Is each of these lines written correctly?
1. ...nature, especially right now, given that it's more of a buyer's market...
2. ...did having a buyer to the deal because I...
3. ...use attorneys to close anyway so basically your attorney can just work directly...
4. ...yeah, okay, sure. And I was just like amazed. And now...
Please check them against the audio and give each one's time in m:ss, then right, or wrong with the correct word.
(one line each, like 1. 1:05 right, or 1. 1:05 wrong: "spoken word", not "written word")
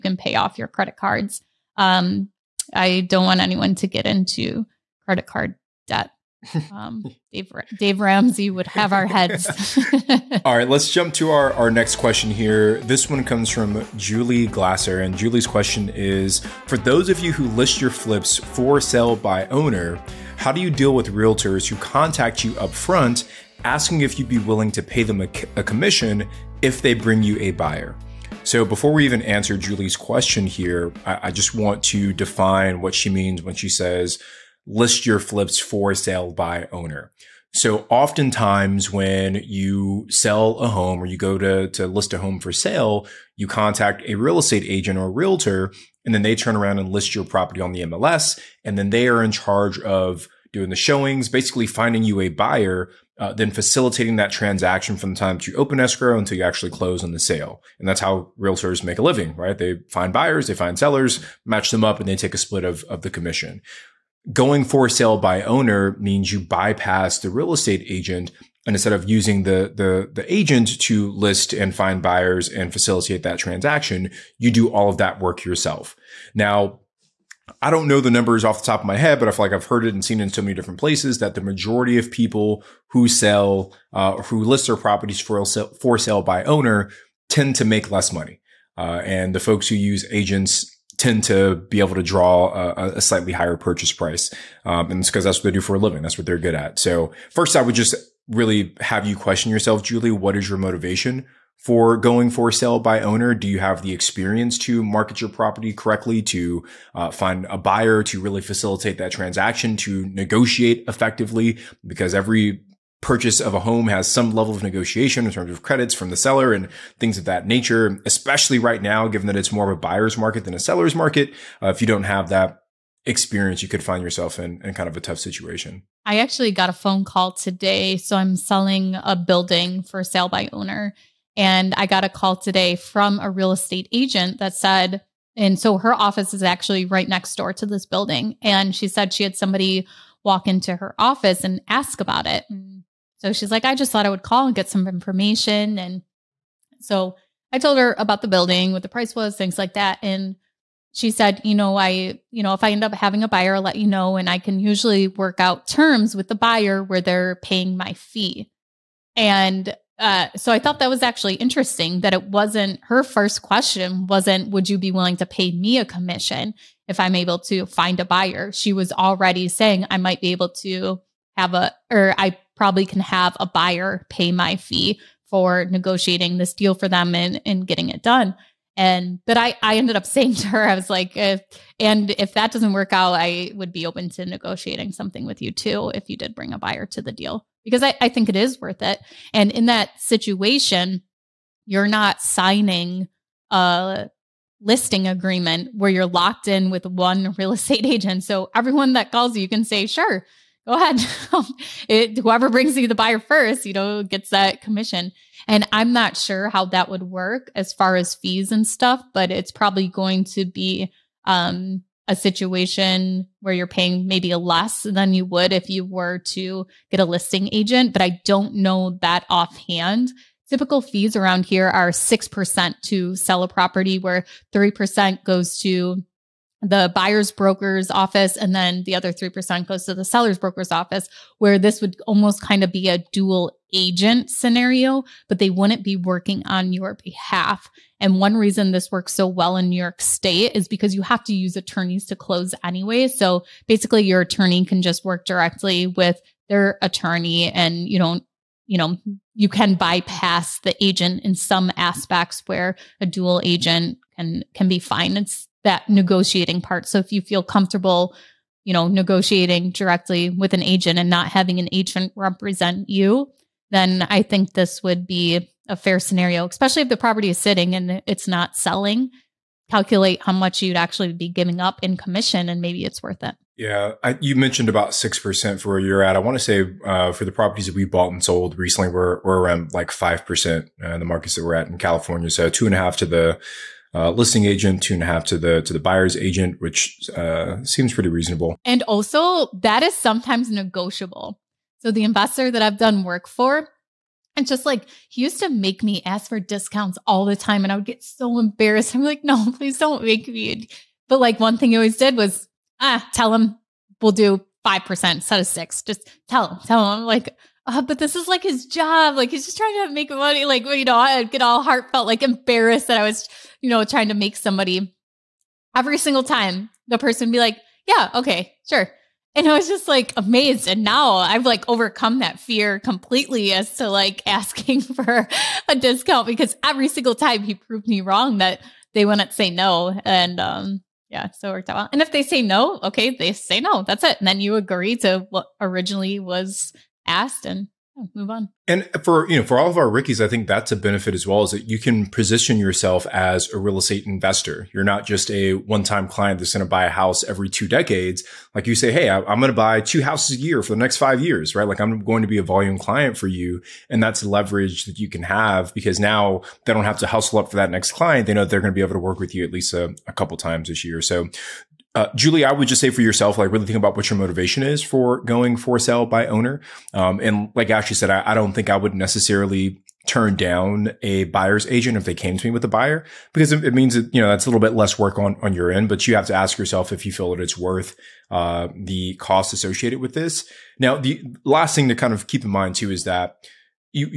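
1. 1:57 right
2. 3:06 wrong: "bring", not "having"
3. 4:01 right
4. 5:17 right.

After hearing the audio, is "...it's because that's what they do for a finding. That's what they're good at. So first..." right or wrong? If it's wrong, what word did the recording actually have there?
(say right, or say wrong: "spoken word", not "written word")
wrong: "living", not "finding".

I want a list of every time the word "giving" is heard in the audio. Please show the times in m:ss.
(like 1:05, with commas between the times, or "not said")
4:31.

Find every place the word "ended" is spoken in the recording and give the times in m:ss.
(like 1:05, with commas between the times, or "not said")
2:59.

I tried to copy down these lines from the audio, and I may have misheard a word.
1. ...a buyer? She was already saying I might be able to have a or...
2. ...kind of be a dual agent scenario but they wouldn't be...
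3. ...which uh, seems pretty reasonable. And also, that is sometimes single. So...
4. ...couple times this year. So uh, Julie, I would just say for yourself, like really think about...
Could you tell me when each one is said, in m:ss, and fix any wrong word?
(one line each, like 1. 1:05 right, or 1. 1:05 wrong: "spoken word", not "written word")
1. 2:47 right
2. 3:52 right
3. 4:46 wrong: "negotiable", not "single"
4. 6:00 right.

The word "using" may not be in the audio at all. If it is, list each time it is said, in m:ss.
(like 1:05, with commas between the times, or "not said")
1:09.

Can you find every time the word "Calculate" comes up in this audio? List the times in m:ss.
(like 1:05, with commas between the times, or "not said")
4:29.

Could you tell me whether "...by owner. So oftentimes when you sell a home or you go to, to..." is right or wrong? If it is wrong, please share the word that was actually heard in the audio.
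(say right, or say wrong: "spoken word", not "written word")
right.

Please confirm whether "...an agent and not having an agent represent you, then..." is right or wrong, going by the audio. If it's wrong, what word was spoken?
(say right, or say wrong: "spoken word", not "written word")
right.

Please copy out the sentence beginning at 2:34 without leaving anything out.
And I can usually work out terms with the buyer where they're paying my fee.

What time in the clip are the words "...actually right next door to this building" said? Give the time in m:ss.
2:16.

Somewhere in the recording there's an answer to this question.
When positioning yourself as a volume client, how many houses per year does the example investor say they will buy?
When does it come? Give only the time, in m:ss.
5:49.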